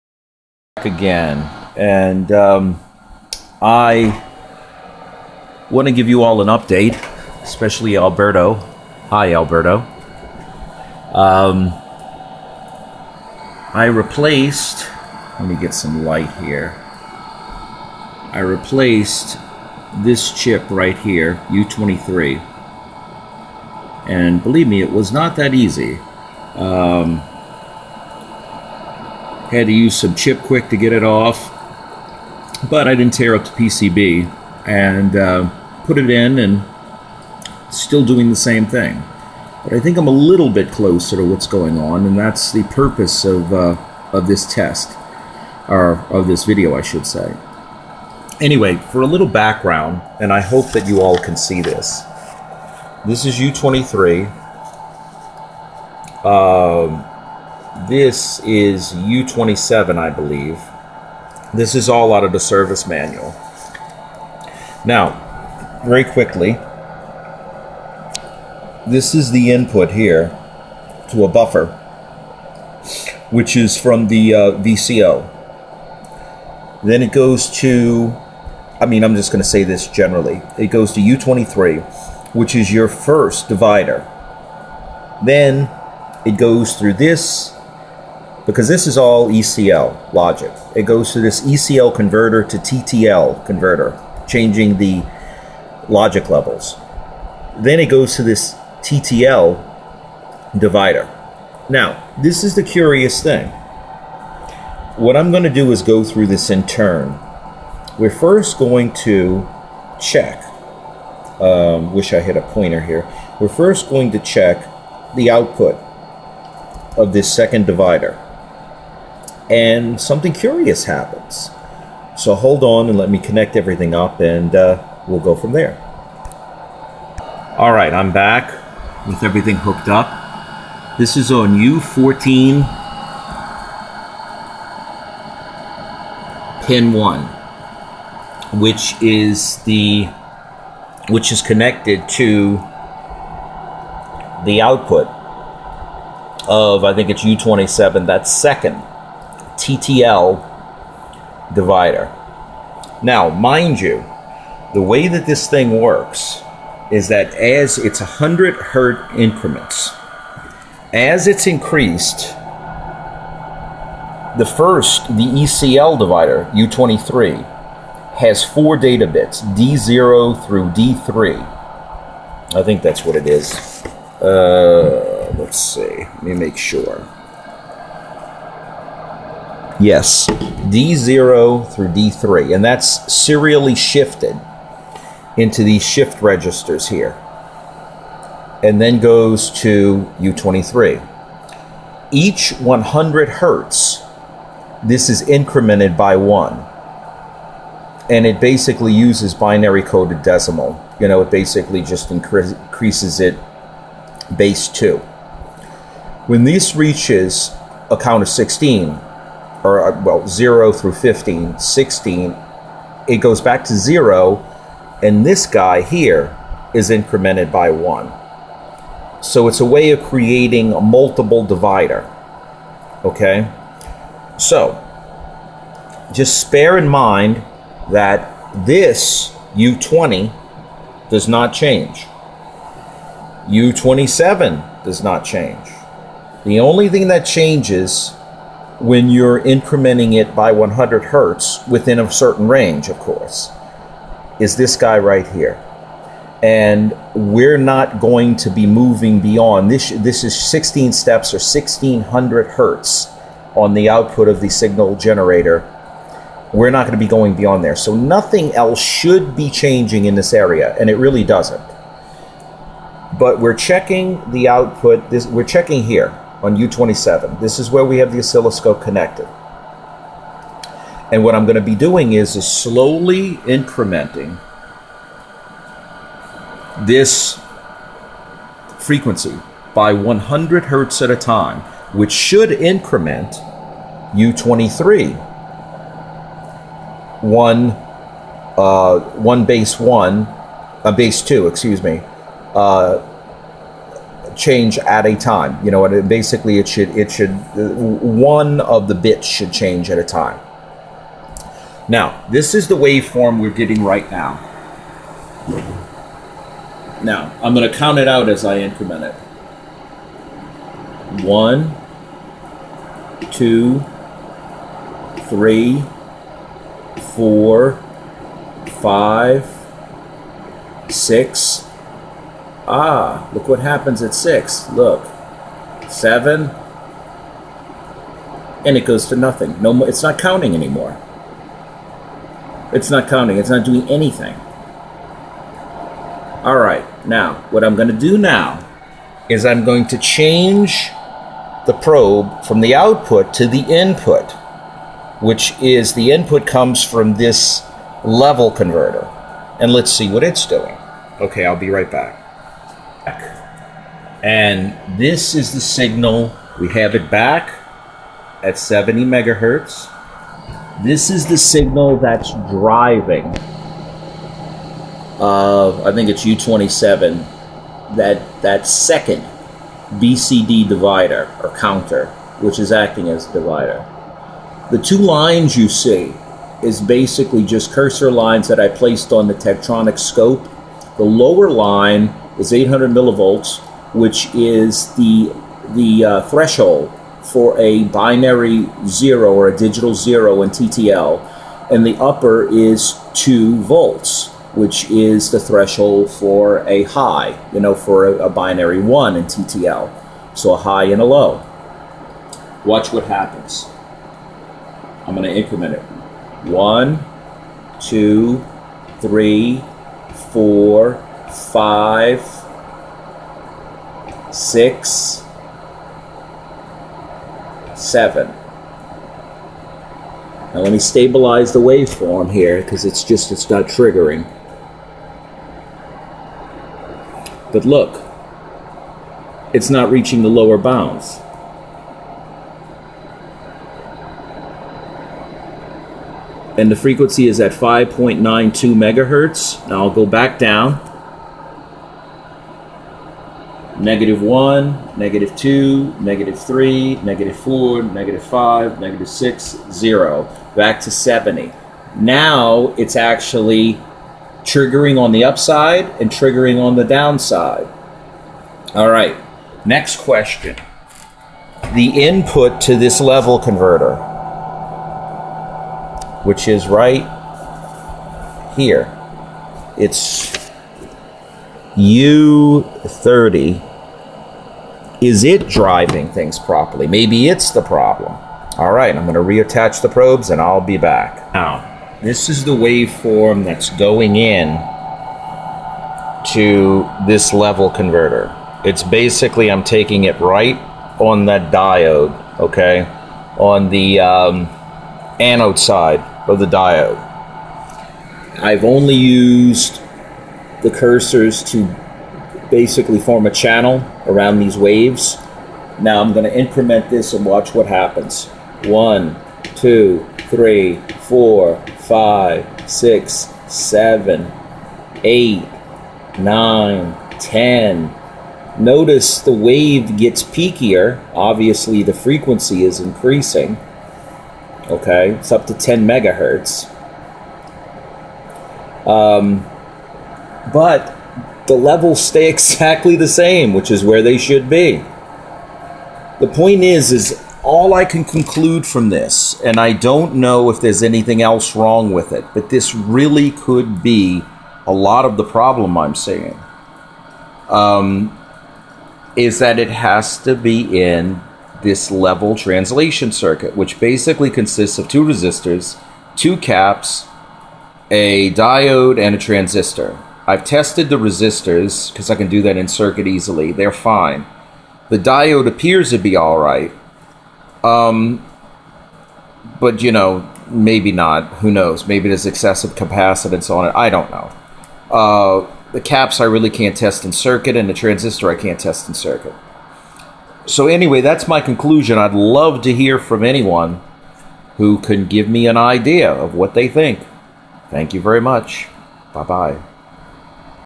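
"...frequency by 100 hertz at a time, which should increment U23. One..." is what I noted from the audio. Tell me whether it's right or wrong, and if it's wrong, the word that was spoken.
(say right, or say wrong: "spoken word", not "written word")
right.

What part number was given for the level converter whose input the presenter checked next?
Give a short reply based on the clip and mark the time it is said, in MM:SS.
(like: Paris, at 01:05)
U30, at 07:51.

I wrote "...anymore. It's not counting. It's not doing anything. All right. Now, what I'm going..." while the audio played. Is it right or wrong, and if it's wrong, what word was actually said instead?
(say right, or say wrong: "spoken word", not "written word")
right.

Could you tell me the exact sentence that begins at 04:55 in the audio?
You know, and it, basically it should it should uh, one of the bits should change at a time.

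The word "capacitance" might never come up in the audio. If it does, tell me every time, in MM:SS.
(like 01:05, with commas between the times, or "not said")
09:32.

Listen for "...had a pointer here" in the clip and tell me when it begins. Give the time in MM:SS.
01:52.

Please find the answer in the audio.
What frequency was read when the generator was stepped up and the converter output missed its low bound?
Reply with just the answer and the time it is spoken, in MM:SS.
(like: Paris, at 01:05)
5.92 megahertz, at 07:17.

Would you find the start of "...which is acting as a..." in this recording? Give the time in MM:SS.
06:12.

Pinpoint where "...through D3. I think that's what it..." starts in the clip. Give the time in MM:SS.
02:50.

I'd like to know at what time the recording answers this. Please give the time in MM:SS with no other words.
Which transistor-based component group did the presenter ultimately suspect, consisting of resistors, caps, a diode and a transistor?
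09:11.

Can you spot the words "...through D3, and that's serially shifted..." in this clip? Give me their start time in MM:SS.
03:01.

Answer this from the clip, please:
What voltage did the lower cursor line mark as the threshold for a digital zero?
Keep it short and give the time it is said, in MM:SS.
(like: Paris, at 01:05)
800 millivolts, at 06:22.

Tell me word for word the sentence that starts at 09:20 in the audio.
I've tested the resistors because I can do that in circuit easily.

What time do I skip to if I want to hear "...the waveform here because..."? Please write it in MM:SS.
07:01.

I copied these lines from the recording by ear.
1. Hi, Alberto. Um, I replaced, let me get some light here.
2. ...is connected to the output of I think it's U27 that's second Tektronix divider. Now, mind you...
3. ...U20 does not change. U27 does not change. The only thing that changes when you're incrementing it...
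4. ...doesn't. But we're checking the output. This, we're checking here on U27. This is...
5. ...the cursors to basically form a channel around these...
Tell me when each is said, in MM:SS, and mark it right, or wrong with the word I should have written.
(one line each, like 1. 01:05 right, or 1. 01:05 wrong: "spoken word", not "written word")
1. 00:09 right
2. 02:21 wrong: "TTL", not "Tektronix"
3. 03:49 right
4. 04:21 right
5. 08:20 right.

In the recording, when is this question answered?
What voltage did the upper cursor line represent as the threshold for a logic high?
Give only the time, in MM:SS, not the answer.
06:33.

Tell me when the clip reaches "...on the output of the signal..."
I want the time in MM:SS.
04:13.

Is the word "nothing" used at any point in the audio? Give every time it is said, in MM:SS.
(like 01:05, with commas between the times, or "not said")
04:17, 05:29.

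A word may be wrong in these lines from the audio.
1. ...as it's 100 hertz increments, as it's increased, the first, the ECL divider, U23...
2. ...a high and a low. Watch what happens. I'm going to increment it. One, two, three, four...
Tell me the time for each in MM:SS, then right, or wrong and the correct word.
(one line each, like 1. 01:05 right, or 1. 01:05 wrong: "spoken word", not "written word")
1. 02:37 right
2. 06:40 right.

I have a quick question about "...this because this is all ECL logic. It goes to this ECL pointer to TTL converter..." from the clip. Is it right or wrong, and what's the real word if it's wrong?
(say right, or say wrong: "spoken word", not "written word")
wrong: "converter", not "pointer".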